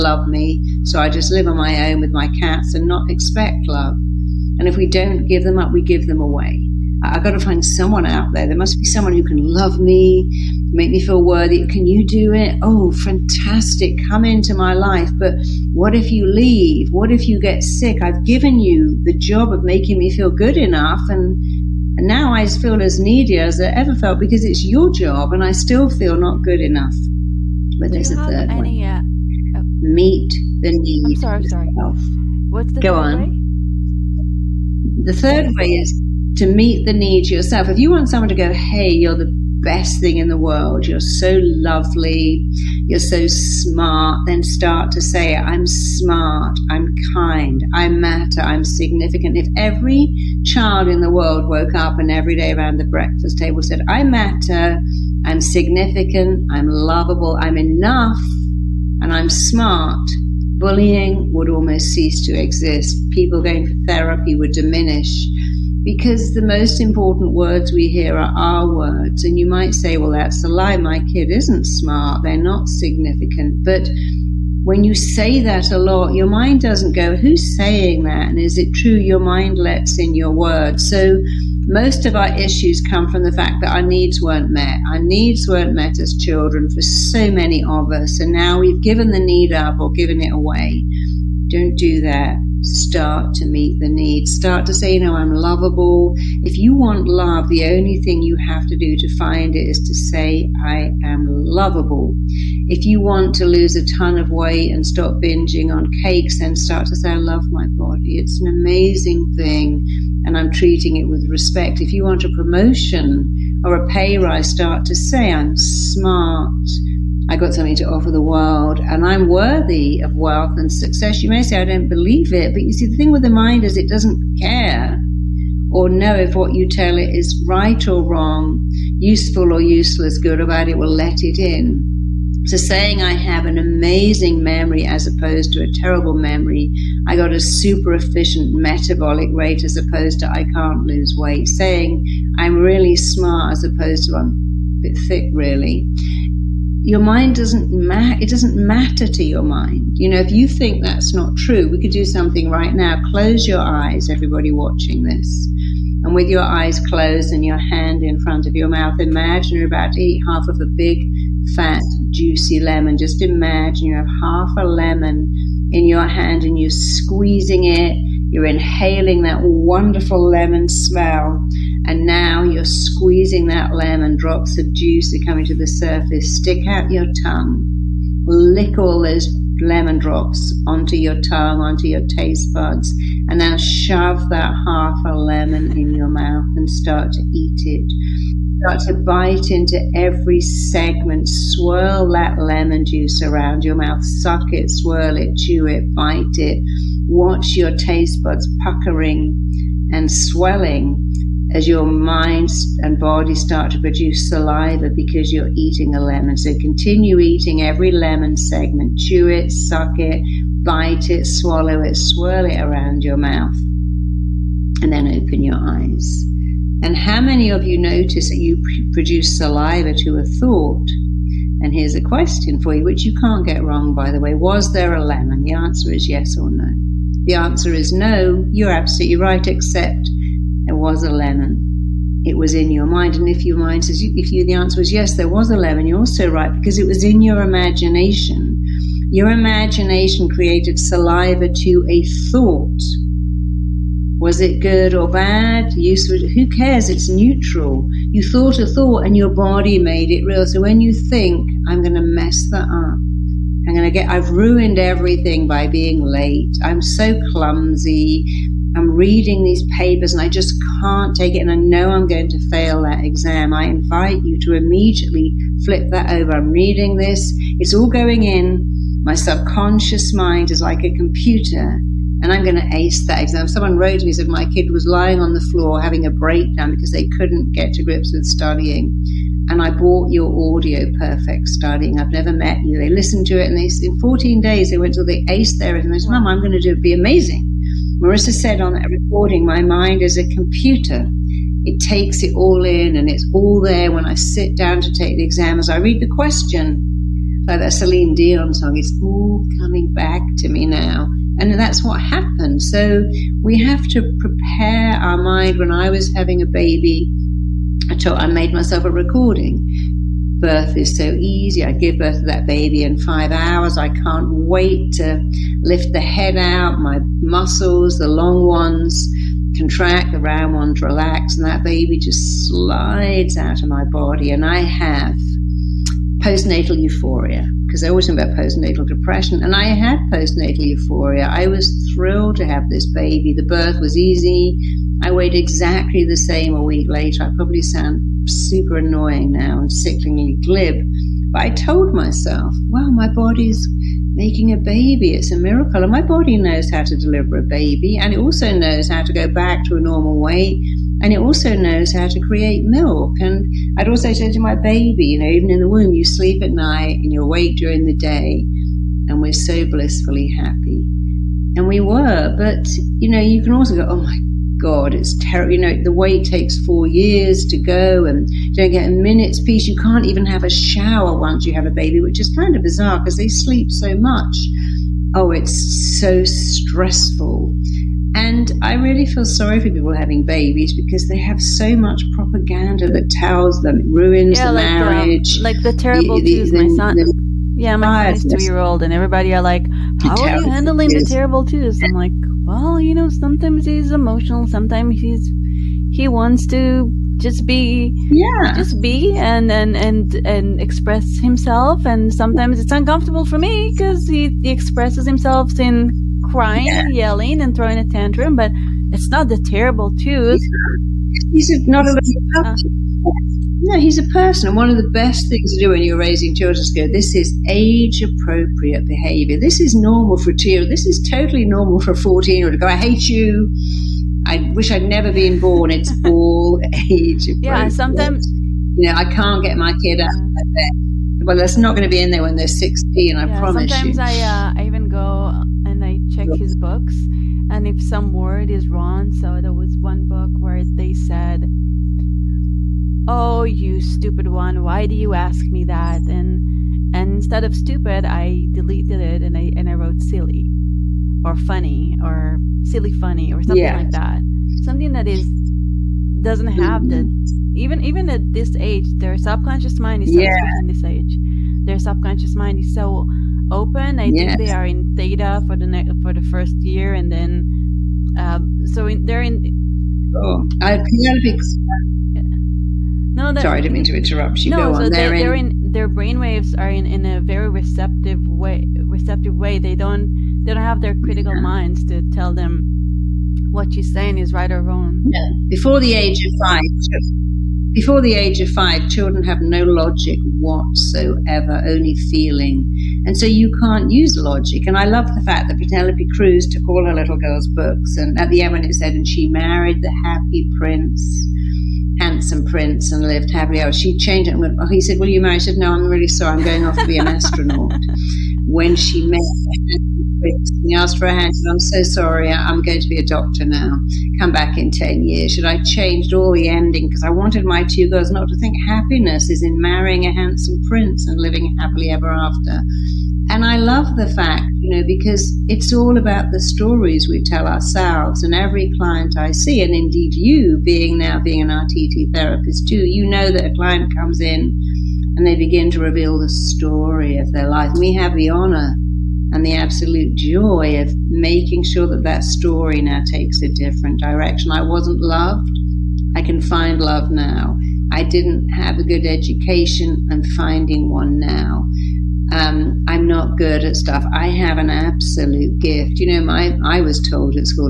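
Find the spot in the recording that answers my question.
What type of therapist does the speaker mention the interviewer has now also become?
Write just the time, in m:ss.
8:51.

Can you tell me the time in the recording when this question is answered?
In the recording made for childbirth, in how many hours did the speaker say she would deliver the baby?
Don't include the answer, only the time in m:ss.
5:12.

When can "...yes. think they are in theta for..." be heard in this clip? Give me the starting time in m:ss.
7:44.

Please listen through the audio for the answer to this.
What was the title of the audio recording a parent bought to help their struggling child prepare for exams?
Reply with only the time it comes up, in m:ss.
4:40.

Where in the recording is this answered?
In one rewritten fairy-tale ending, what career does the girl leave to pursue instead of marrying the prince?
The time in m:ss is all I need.
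8:27.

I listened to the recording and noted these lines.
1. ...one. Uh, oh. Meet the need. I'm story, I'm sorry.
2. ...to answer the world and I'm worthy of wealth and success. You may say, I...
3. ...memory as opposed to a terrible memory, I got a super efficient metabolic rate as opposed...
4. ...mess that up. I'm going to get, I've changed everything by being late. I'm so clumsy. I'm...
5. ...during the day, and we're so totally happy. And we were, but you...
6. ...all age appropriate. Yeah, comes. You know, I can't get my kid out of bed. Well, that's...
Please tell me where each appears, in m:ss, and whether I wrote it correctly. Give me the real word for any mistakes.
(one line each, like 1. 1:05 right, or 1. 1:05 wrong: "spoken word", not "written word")
1. 0:28 wrong: "sorry", not "story"
2. 1:57 wrong: "offer", not "answer"
3. 2:14 right
4. 4:12 wrong: "ruined", not "changed"
5. 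5:57 wrong: "blissfully", not "totally"
6. 7:06 wrong: "sometimes", not "comes".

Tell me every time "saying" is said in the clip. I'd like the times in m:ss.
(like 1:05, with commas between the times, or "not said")
1:17, 2:12, 2:21, 8:03.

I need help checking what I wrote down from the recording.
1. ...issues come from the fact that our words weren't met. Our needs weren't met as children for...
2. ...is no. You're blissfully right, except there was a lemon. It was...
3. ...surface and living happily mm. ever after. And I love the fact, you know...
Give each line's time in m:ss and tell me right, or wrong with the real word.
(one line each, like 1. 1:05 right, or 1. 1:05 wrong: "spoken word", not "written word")
1. 1:22 wrong: "needs", not "words"
2. 3:47 wrong: "absolutely", not "blissfully"
3. 8:40 wrong: "prince", not "surface".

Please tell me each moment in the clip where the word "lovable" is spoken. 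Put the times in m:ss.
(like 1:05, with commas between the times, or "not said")
0:56, 1:35, 1:41.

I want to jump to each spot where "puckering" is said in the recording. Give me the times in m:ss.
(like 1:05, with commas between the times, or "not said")
3:18.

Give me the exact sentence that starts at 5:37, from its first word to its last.
I probably sound super annoying now and sickeningly glib, but I told myself, well, my body's making a baby.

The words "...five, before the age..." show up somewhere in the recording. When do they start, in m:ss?
8:06.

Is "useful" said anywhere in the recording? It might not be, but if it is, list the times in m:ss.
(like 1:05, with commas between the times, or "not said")
2:08, 4:05.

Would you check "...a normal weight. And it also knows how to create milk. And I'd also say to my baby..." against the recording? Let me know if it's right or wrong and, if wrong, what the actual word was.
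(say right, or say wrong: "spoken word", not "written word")
right.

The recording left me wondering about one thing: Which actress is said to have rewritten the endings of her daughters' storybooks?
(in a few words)
Penelope Cruz.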